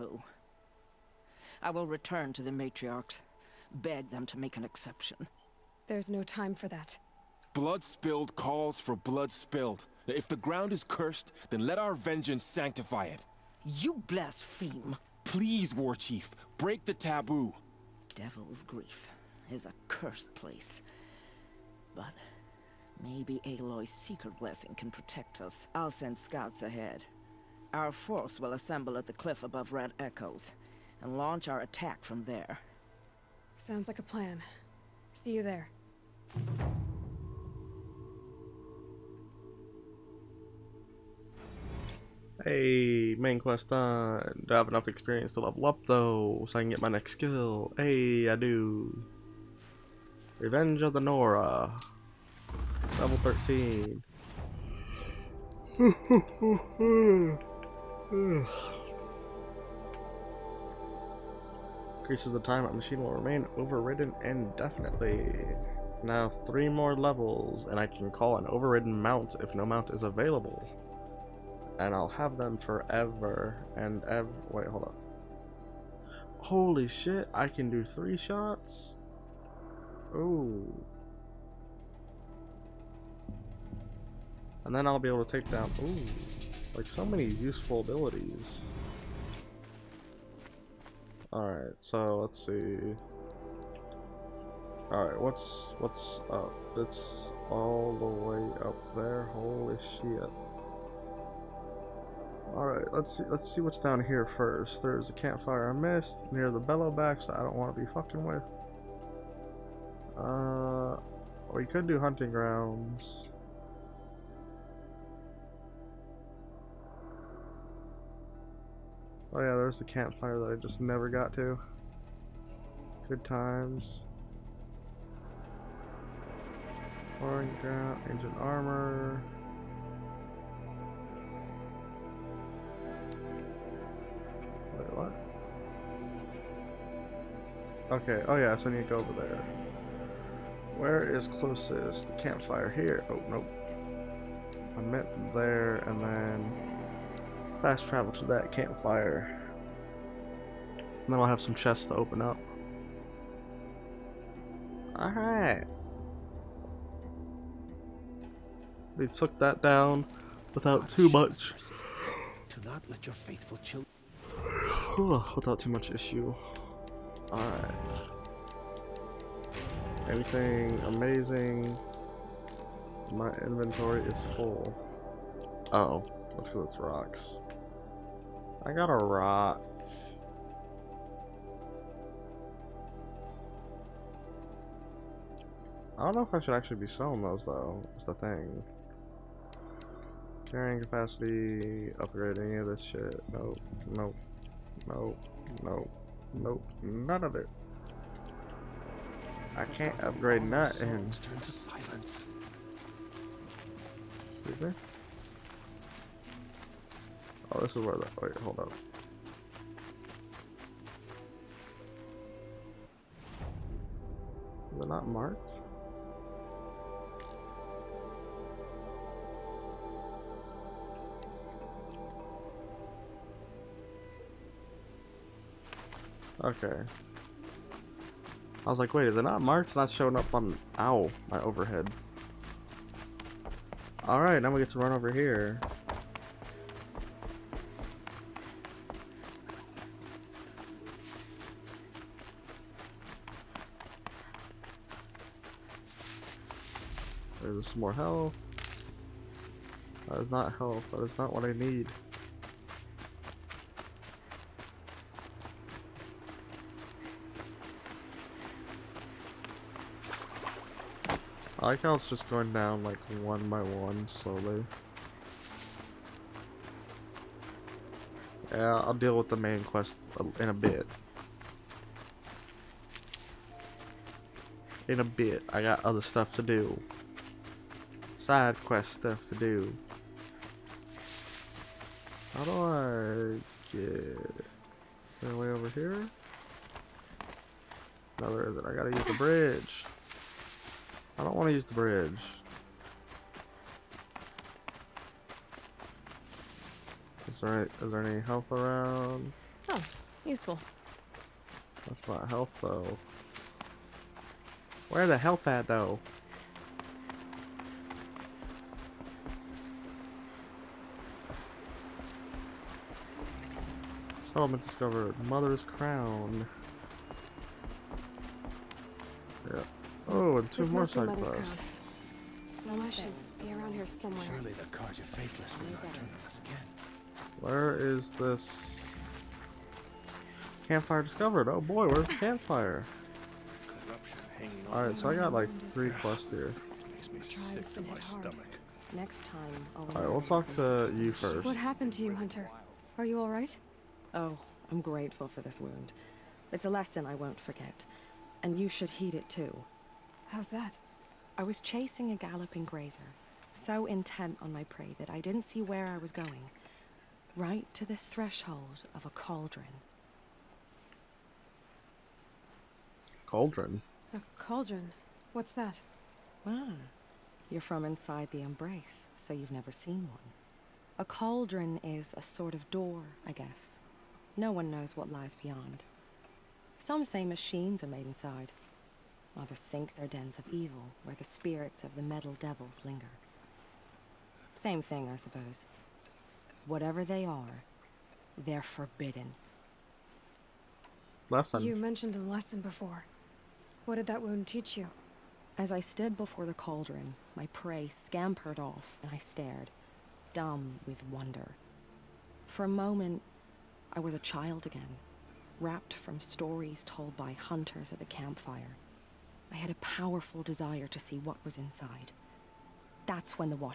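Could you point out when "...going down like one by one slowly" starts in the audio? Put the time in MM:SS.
04:22.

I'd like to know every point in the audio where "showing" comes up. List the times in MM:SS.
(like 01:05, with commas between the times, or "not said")
03:49.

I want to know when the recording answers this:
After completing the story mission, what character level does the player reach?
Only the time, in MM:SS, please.
00:52.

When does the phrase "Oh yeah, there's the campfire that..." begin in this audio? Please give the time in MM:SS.
01:59.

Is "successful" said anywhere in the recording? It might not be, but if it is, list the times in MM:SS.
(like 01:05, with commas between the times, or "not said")
not said.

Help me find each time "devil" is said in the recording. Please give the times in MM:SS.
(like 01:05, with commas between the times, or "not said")
00:18, 06:22.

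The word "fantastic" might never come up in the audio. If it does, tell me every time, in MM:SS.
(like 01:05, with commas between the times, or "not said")
not said.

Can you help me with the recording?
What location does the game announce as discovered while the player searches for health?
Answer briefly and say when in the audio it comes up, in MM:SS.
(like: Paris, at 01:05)
Mother's Crown, at 05:15.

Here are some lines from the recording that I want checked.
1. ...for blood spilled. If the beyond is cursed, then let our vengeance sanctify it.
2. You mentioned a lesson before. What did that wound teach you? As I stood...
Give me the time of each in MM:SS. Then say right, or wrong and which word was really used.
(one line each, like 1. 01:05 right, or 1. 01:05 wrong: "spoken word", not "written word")
1. 00:08 wrong: "ground", not "beyond"
2. 06:31 right.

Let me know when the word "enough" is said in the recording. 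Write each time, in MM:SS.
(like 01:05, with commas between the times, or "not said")
00:44.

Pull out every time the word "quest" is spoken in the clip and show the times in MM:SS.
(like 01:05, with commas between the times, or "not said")
00:43, 04:29, 04:38, 05:21, 05:35.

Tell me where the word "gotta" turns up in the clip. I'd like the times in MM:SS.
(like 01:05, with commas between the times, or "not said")
04:48.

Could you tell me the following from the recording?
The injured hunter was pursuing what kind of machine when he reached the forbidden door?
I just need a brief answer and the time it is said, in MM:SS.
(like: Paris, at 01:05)
galloping grazer, at 05:52.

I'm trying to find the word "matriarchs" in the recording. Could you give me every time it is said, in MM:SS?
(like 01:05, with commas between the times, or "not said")
00:02.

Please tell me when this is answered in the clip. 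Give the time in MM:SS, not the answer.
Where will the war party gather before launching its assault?
00:29.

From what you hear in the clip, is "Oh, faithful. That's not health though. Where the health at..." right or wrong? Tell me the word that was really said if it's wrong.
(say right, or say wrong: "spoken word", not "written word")
wrong: "useful", not "faithful".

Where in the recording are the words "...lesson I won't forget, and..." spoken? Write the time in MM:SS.
05:46.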